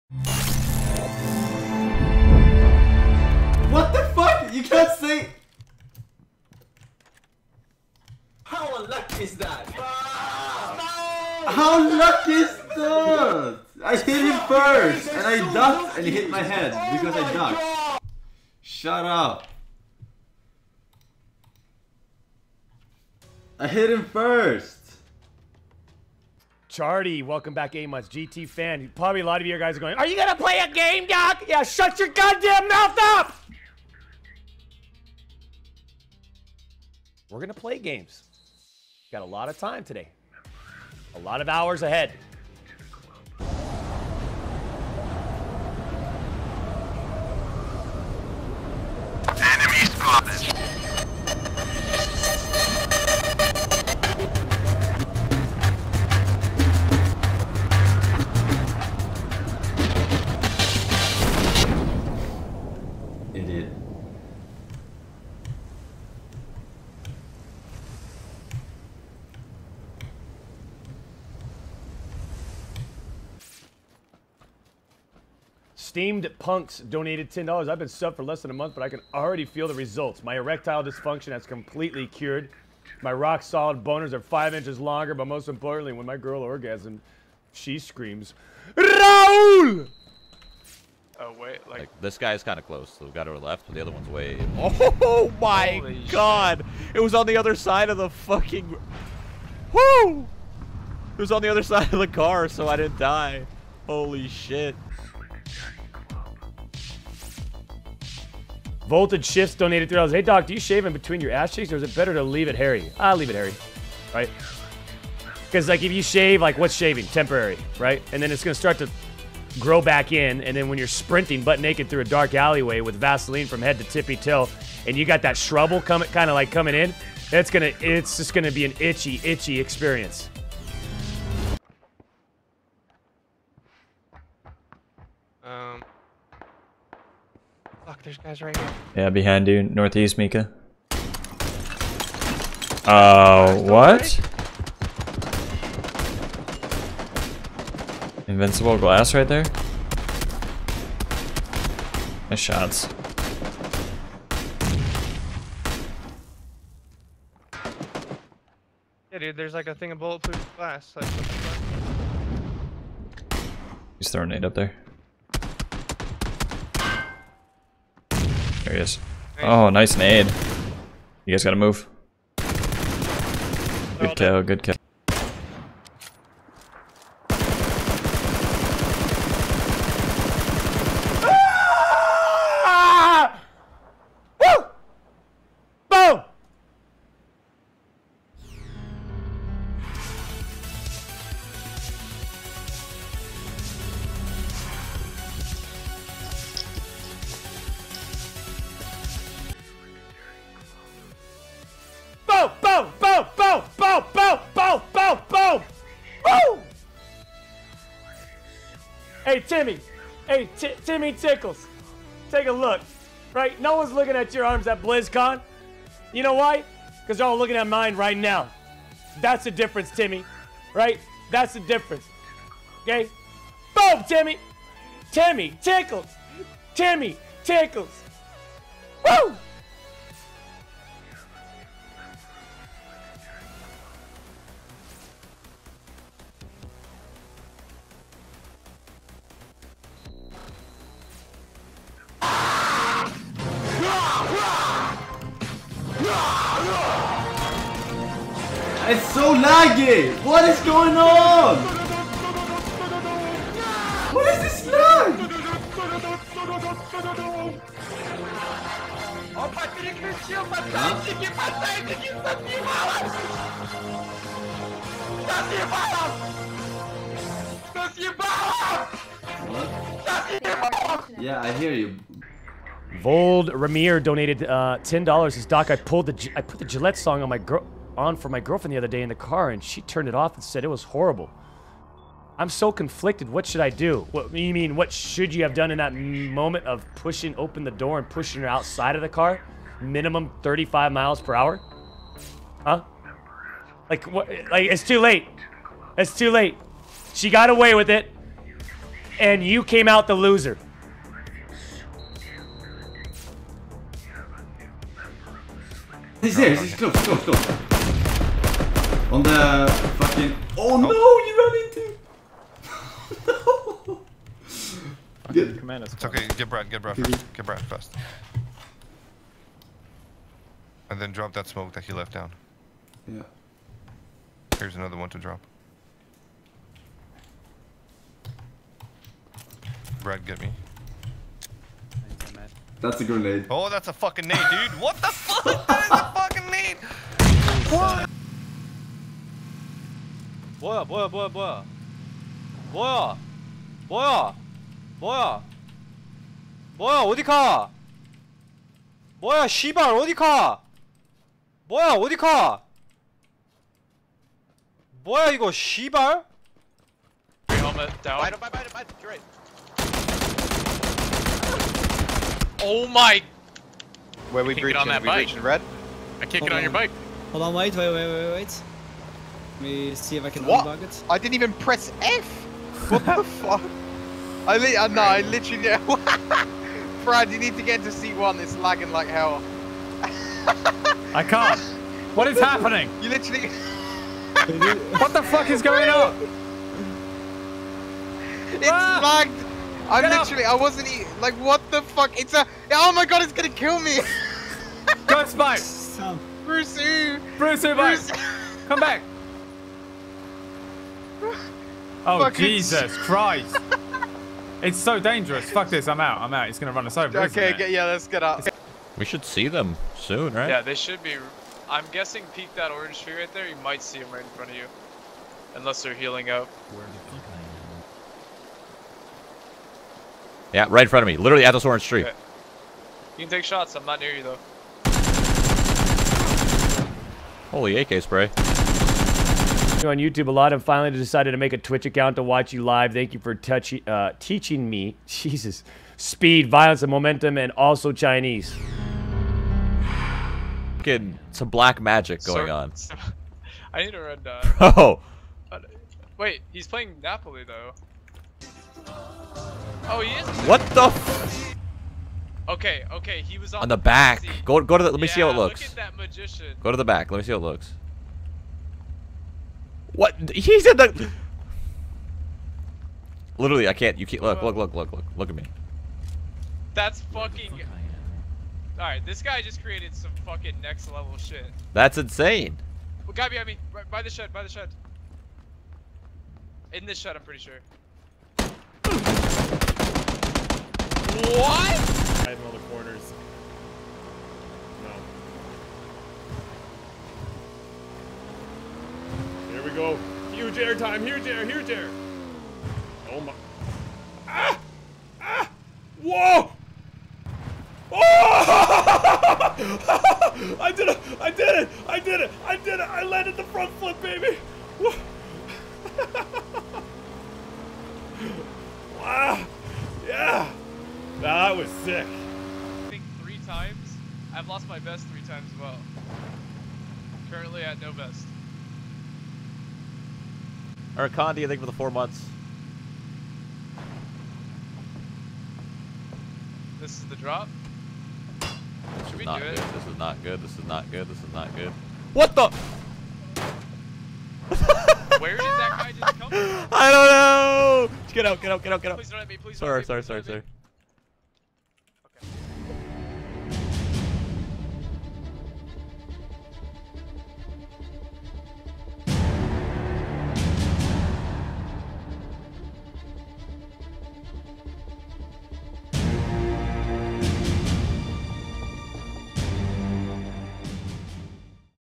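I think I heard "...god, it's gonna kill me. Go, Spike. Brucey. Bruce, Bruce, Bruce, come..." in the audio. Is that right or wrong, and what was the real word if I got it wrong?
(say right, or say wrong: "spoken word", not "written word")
right.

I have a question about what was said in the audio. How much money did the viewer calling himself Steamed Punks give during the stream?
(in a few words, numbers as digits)
$10.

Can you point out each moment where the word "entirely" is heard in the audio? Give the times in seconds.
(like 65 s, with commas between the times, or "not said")
not said.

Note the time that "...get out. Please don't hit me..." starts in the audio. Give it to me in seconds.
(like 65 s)
538 s.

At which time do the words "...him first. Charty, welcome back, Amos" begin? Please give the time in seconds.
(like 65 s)
23 s.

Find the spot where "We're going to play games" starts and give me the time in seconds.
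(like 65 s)
37 s.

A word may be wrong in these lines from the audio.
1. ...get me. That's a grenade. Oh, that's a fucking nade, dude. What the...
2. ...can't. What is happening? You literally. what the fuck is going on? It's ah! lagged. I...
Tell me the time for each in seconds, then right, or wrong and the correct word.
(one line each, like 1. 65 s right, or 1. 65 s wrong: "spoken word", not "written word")
1. 330 s right
2. 381 s right.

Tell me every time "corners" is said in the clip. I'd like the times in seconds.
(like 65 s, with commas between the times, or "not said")
482 s.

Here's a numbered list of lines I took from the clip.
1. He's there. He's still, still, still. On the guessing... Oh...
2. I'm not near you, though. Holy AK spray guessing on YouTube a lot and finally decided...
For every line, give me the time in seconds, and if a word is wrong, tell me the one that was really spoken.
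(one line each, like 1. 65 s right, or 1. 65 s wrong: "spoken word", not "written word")
1. 306 s wrong: "fucking", not "guessing"
2. 423 s wrong: "watching", not "guessing".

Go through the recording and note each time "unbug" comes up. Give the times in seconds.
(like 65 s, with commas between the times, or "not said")
370 s.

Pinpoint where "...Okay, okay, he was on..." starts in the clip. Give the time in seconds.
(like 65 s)
452 s.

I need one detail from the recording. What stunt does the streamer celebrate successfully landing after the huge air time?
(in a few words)
front flip.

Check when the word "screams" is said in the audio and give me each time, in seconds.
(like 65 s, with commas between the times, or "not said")
87 s.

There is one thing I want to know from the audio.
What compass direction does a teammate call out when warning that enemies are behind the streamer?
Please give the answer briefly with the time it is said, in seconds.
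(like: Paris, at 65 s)
Northeast, at 139 s.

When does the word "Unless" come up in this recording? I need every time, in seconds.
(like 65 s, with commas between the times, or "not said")
415 s.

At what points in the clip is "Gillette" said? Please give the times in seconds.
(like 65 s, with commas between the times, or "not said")
276 s.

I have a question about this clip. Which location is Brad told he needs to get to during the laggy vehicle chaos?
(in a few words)
C1.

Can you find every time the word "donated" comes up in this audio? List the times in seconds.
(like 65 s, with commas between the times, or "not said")
76 s, 109 s, 274 s.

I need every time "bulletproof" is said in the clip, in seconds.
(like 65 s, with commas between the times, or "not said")
159 s.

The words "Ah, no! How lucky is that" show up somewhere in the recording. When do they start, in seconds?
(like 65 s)
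9 s.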